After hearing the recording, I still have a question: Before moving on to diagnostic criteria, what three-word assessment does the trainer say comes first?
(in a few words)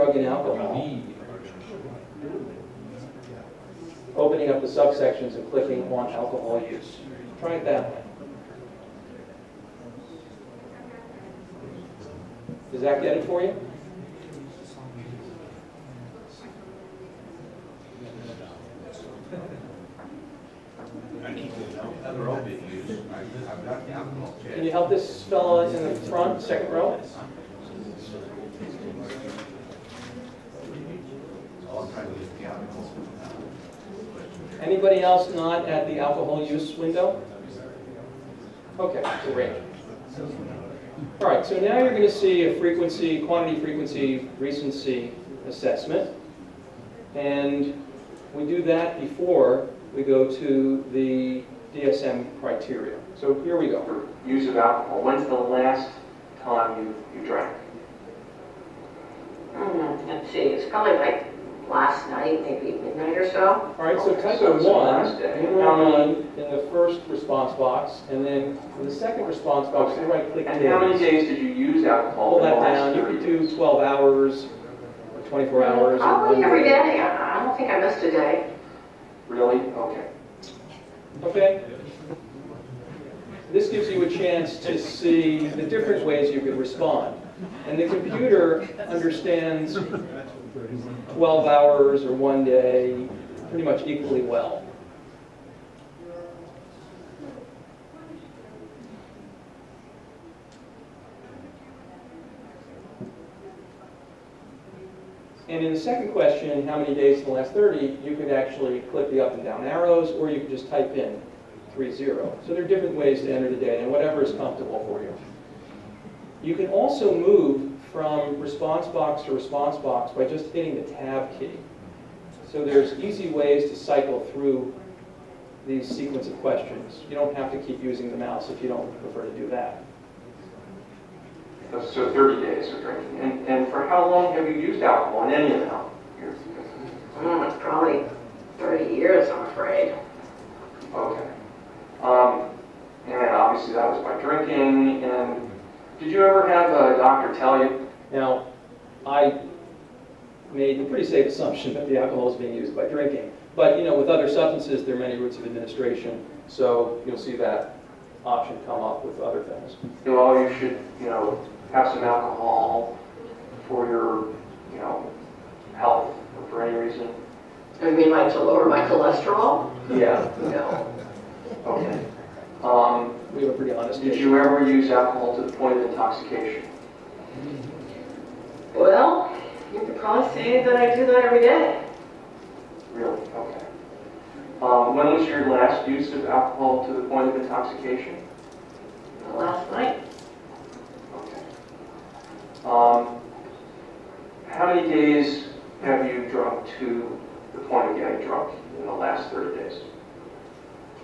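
quantity frequency recency.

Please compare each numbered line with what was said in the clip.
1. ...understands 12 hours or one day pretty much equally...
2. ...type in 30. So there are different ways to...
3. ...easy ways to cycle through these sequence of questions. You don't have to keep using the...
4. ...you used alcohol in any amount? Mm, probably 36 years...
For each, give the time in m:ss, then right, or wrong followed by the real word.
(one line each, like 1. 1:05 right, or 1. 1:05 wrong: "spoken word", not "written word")
1. 1:28 right
2. 1:50 right
3. 2:02 right
4. 2:14 wrong: "30", not "36".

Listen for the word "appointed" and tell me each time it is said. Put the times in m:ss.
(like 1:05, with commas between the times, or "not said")
not said.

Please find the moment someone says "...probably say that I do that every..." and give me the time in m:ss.
2:59.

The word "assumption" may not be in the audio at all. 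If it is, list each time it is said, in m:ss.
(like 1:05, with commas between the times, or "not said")
2:31.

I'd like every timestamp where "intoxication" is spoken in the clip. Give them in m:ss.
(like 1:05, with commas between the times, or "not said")
2:55, 3:07.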